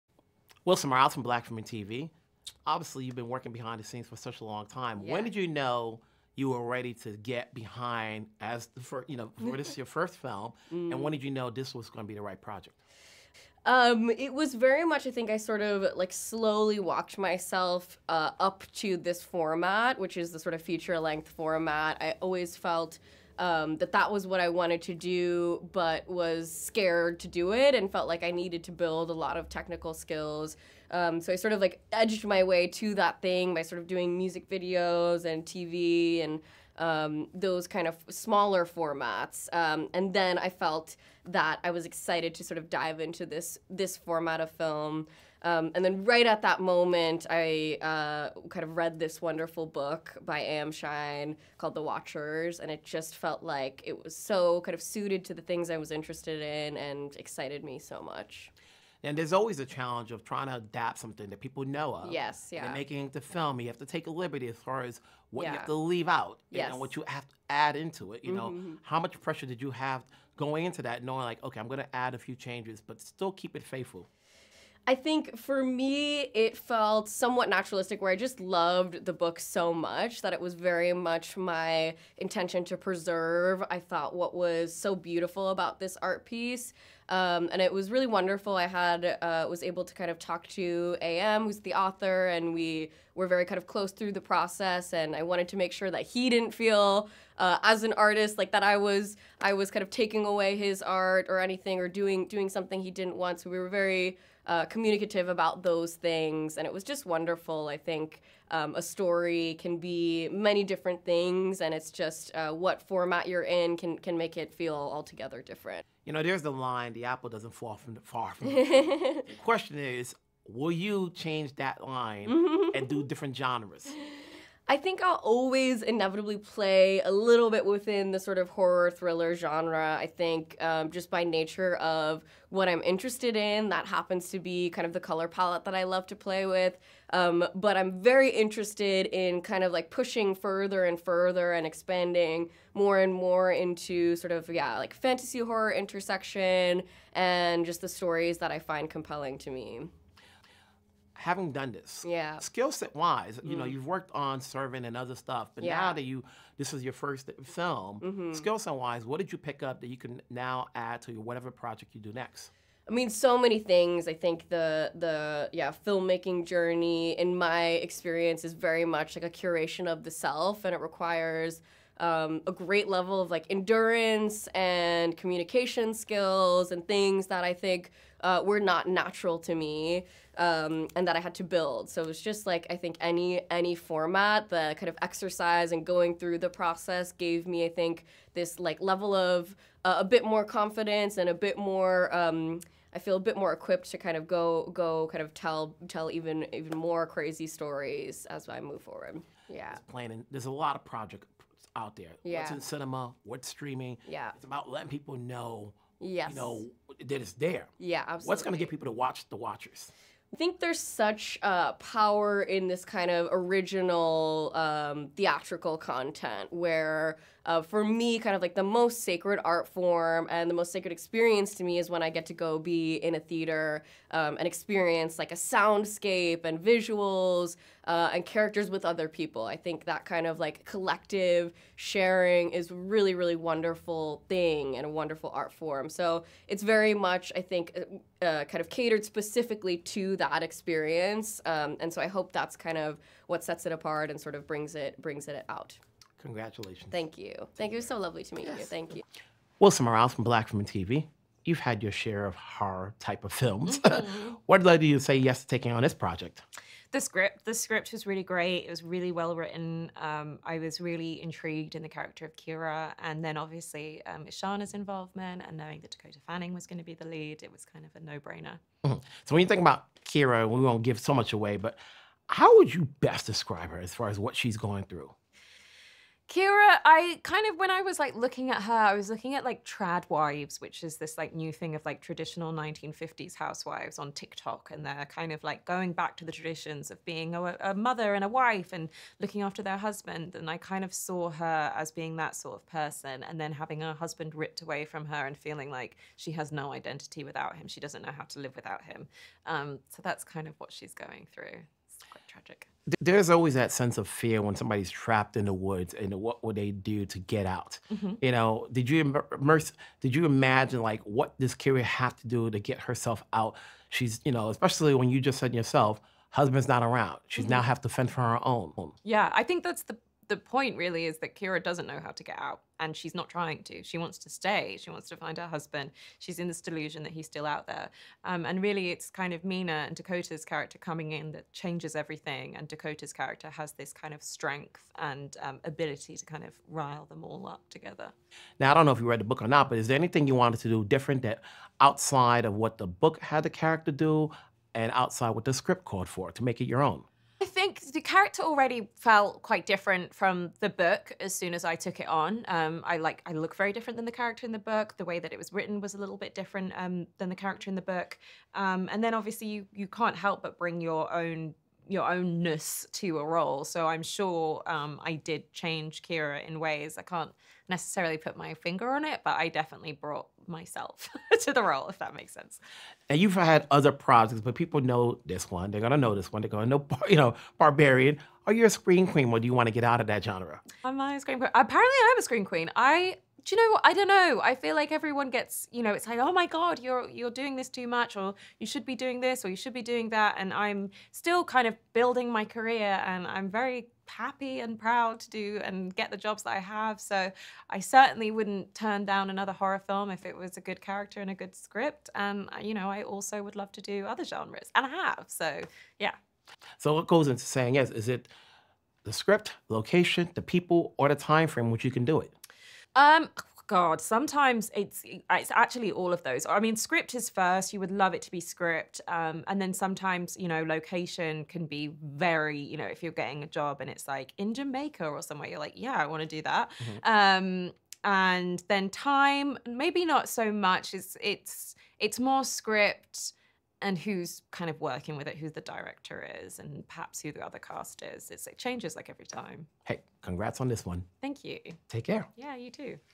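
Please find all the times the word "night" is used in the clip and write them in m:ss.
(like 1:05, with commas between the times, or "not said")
not said.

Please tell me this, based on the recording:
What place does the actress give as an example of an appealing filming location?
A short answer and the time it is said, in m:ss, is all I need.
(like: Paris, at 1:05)
Jamaica, at 7:04.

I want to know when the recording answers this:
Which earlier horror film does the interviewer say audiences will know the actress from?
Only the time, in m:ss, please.
6:17.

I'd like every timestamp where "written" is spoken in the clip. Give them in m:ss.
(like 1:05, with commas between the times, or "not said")
4:19, 5:55.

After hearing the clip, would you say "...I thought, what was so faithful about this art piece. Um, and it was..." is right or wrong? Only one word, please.
wrong.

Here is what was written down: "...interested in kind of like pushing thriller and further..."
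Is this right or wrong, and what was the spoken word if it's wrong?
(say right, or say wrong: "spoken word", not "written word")
wrong: "further", not "thriller".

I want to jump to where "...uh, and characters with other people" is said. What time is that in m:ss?
3:47.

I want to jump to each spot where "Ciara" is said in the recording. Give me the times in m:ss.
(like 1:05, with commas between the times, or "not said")
4:22, 4:30, 4:36, 5:11, 5:21, 6:06.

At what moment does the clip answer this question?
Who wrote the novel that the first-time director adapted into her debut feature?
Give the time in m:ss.
0:50.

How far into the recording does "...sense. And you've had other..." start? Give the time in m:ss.
6:12.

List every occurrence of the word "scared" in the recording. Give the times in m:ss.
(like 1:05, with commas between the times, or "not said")
0:26.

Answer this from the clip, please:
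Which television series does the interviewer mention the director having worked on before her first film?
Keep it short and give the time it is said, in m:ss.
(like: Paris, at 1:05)
Servant, at 2:34.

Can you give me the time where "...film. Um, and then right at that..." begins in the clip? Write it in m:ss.
0:44.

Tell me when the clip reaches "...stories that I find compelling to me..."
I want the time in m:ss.
2:27.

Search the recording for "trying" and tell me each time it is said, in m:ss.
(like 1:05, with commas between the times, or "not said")
1:00, 5:23.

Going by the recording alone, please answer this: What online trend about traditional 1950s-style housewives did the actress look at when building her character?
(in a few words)
trad wives.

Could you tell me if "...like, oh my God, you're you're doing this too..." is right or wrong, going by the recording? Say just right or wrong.
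right.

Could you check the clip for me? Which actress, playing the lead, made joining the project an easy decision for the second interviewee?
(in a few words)
Dakota Fanning.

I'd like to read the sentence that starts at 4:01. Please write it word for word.
Um, and so I hope that's kind of what sets it apart and sort of brings it brings it out.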